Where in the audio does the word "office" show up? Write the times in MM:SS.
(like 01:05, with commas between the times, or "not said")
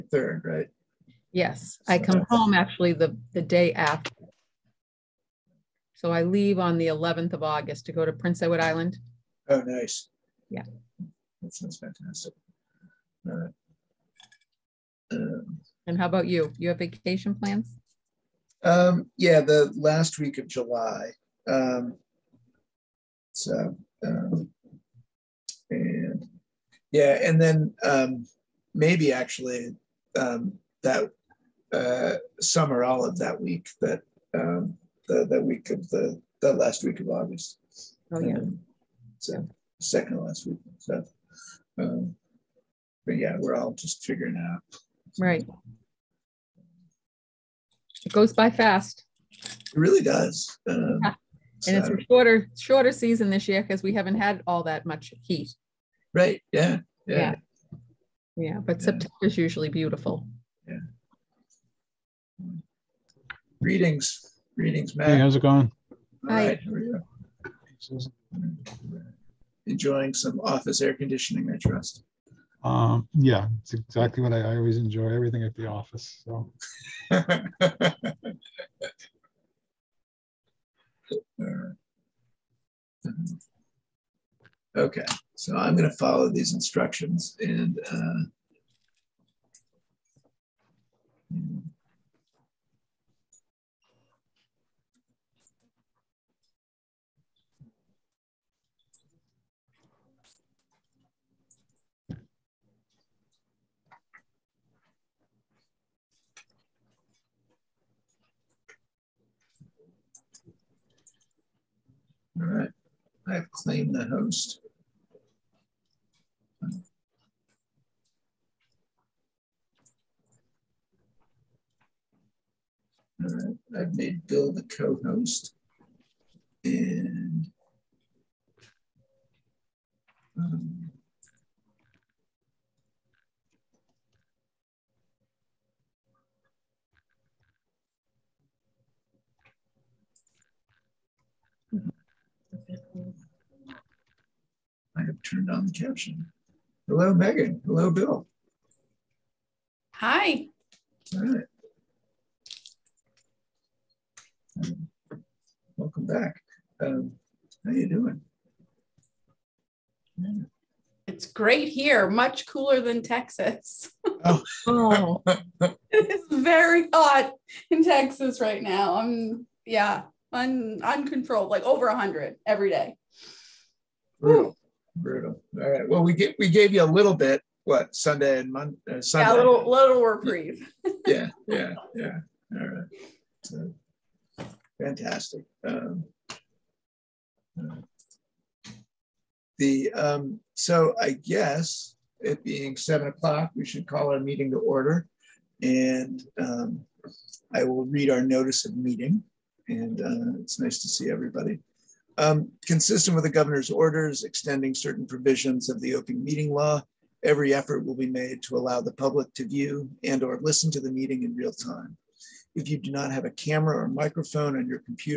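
01:10, 01:15.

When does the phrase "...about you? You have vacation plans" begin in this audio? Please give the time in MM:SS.
00:16.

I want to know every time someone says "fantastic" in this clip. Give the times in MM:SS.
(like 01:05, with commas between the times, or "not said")
00:11, 03:04.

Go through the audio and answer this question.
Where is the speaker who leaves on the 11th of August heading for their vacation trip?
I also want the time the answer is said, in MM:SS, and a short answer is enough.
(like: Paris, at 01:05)
Prince Edward Island, at 00:08.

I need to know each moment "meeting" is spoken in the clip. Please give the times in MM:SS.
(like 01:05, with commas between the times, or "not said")
03:14, 03:18, 03:26, 03:30.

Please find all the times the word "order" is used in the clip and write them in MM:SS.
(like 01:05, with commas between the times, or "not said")
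03:14, 03:23.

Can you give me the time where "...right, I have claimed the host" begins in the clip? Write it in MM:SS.
01:52.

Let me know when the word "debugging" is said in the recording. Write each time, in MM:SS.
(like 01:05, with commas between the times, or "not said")
not said.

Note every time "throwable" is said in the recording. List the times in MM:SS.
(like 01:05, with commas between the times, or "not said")
not said.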